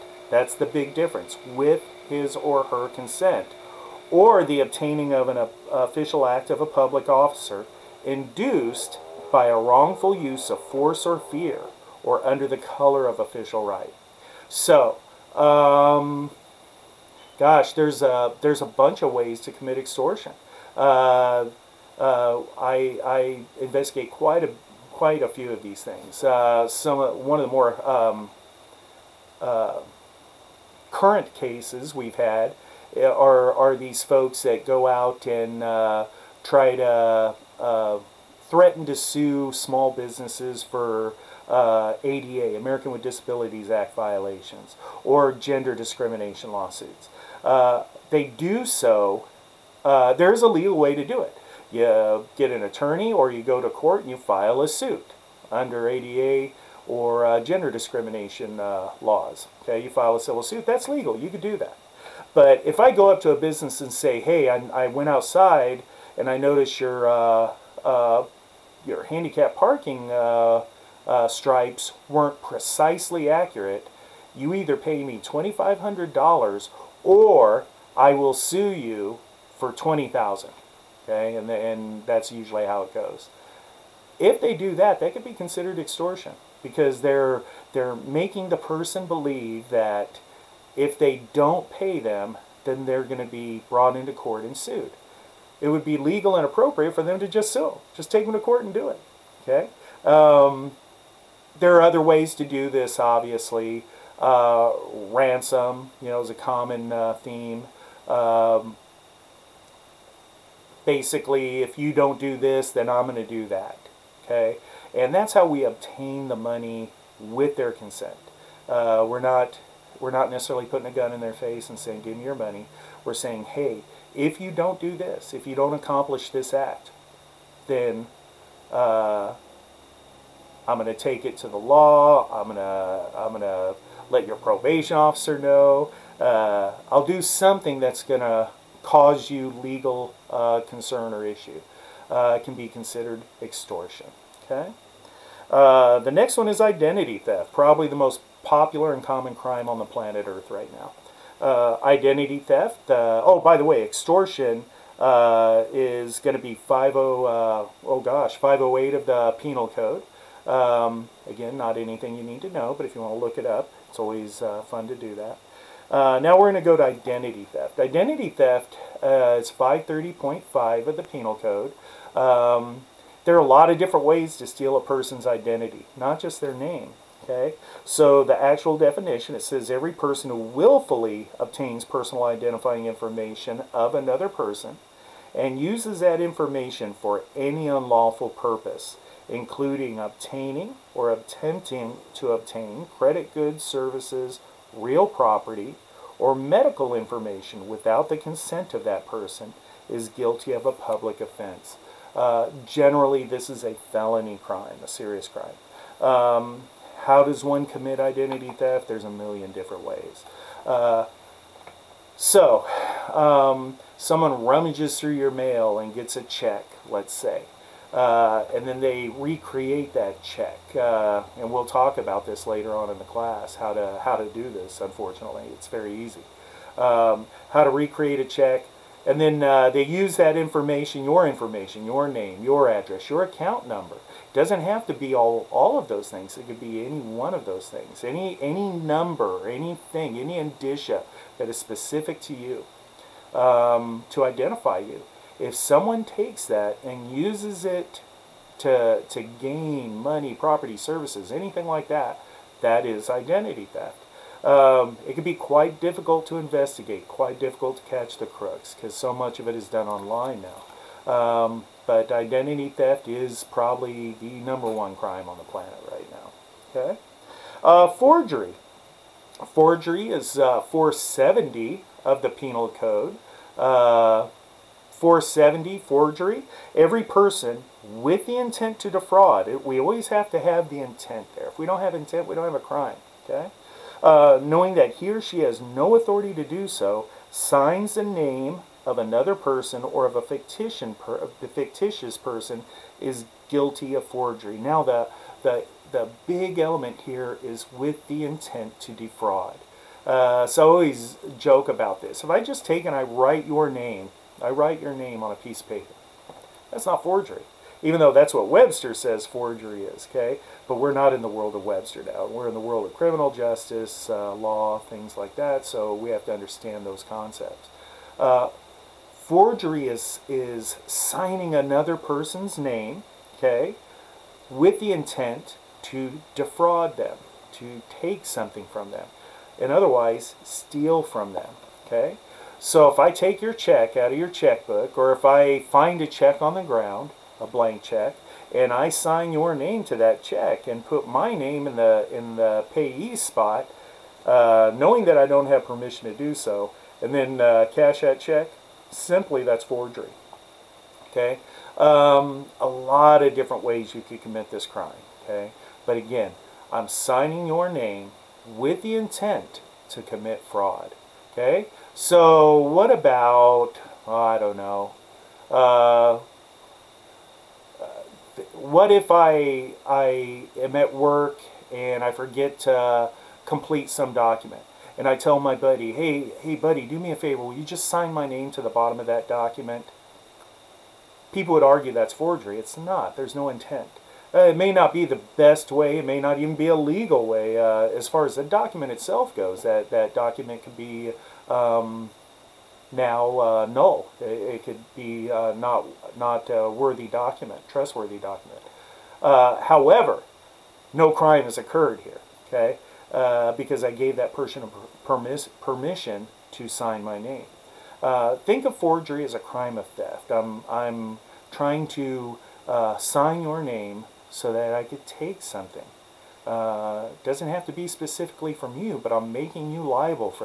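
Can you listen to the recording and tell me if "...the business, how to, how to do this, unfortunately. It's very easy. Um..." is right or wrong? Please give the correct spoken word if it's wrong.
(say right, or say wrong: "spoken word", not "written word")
wrong: "class", not "business".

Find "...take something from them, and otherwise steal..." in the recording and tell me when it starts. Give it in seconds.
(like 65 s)
328 s.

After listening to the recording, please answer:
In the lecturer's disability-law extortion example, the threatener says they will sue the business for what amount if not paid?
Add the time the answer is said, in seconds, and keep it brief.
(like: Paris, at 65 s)
20,000, at 79 s.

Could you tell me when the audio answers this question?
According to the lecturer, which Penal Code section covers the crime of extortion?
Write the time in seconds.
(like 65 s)
158 s.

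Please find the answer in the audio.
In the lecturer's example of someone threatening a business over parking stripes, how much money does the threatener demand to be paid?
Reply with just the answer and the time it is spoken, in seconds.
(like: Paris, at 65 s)
$2,500, at 75 s.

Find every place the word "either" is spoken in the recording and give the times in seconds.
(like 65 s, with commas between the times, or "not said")
74 s.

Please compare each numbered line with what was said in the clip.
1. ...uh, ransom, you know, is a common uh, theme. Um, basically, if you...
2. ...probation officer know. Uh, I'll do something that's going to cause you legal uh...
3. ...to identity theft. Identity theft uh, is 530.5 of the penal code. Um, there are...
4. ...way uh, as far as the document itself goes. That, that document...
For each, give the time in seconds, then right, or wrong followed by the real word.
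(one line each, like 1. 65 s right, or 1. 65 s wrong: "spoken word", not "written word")
1. 104 s right
2. 134 s right
3. 166 s right
4. 387 s right.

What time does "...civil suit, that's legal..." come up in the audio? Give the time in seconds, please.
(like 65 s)
60 s.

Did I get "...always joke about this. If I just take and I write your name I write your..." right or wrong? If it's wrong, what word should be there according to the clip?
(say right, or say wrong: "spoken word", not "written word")
right.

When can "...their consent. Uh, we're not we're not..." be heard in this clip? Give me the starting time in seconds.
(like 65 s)
117 s.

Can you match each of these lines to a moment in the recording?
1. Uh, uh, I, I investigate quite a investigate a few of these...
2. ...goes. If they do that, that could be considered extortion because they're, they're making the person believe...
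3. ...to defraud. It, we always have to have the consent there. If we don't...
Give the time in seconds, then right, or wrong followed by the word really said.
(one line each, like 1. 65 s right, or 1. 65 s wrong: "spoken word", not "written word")
1. 20 s wrong: "quite", not "investigate"
2. 82 s right
3. 278 s wrong: "intent", not "consent".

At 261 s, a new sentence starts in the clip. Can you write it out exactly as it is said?
Um, but identity theft is probably the number one crime on the planet right now.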